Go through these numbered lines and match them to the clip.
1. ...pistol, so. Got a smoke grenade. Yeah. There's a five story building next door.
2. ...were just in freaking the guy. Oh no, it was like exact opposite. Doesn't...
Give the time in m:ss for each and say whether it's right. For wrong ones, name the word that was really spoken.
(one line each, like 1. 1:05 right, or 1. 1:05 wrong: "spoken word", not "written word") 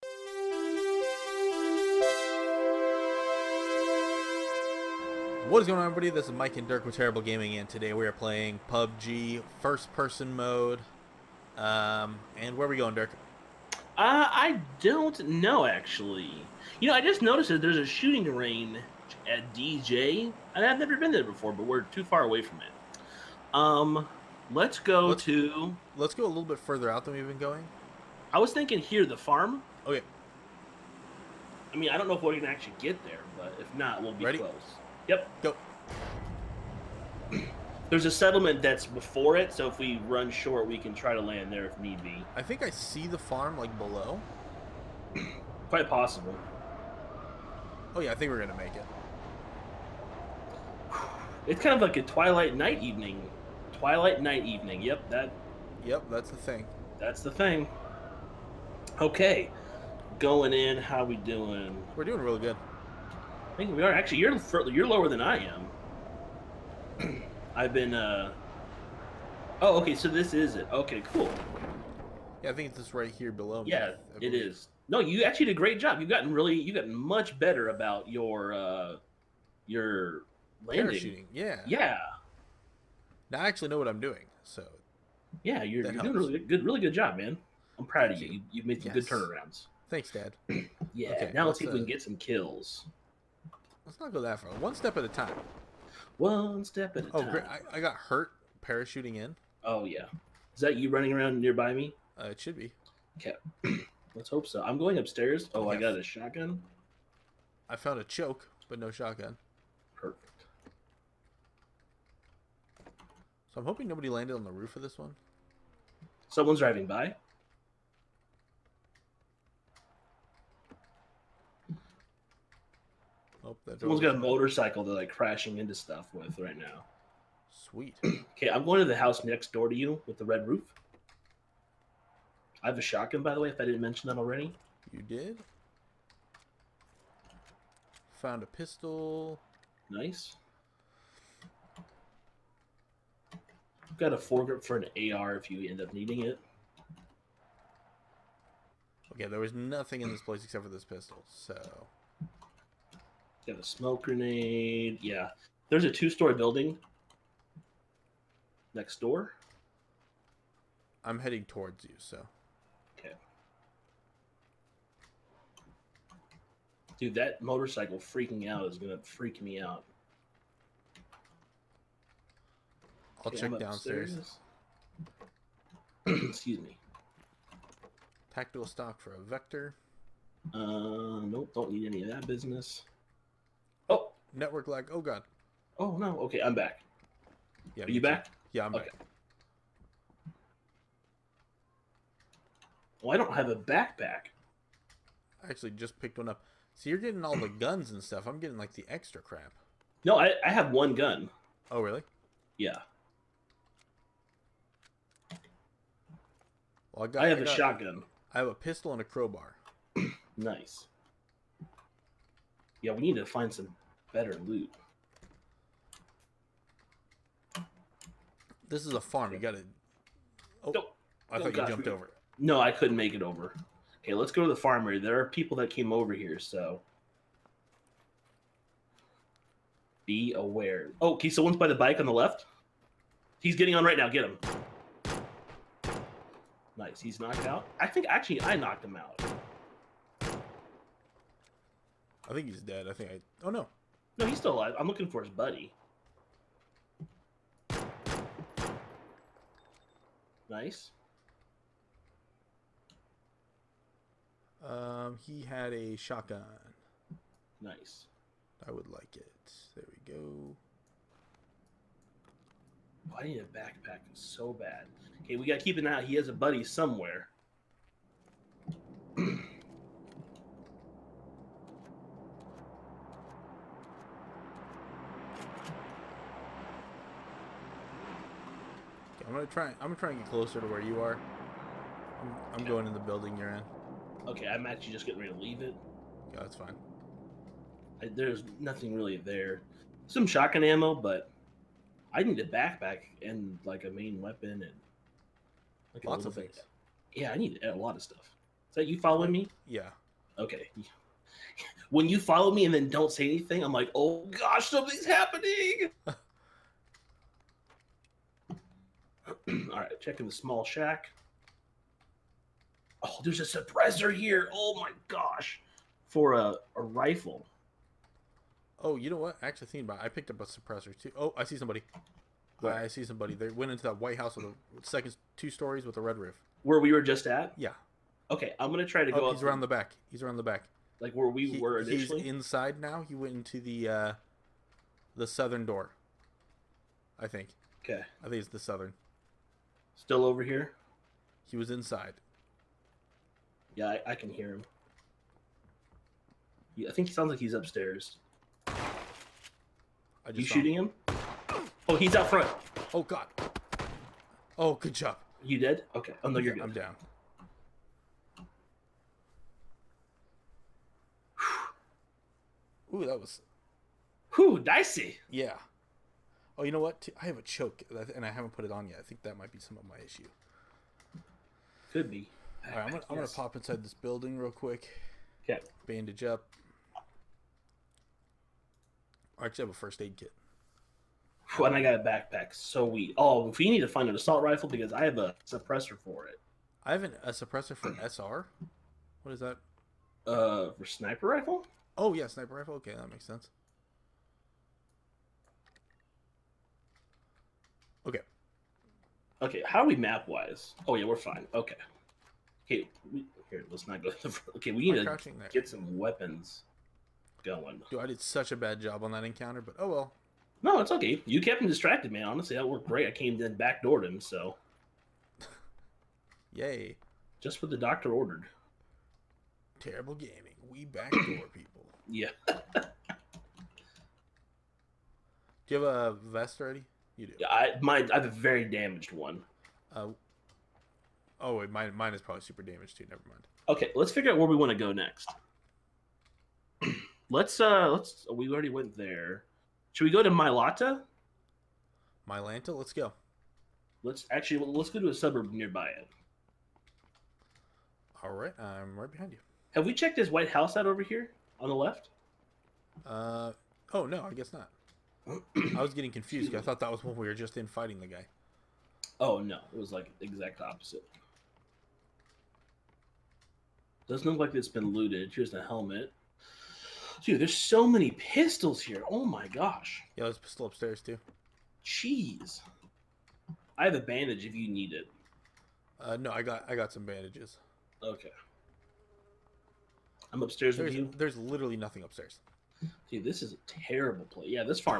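1. 2:30 wrong: "two", not "five"
2. 7:37 wrong: "fighting", not "freaking".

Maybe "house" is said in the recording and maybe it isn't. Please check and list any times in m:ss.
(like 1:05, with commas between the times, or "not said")
2:08, 5:24, 7:30.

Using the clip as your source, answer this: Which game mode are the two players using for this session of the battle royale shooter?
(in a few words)
First person mode.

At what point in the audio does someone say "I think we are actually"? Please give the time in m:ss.
1:03.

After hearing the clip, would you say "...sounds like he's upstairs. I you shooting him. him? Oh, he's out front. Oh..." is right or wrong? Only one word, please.
right.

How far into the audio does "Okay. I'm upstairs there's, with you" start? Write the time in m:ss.
7:58.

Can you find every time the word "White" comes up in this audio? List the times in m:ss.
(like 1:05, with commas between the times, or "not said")
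5:24, 7:30.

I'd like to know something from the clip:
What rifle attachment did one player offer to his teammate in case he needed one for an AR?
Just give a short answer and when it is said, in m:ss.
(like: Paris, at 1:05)
Foregrip, at 2:24.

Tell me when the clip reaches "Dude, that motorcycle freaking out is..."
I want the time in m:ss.
2:46.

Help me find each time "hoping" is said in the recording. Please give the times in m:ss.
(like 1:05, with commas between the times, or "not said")
1:53.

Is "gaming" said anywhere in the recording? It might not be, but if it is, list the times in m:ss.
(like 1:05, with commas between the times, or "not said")
0:07, 7:00.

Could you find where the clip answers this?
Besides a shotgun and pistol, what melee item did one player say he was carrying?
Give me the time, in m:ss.
3:29.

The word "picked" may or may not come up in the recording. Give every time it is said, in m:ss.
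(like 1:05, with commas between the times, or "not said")
3:16, 5:20.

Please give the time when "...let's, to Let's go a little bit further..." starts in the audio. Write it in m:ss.
0:25.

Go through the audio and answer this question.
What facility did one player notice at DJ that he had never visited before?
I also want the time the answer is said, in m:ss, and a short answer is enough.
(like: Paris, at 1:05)
A shooting range, at 0:17.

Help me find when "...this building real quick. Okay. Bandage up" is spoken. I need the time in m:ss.
6:13.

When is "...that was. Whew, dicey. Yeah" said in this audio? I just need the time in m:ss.
6:03.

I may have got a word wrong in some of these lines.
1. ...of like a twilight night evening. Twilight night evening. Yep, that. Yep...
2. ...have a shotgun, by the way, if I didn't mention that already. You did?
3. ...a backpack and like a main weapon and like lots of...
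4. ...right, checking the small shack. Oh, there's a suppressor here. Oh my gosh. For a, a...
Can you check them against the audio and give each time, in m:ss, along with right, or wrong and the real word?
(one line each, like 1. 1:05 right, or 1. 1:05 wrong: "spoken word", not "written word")
1. 0:51 right
2. 2:12 right
3. 4:52 right
4. 5:09 right.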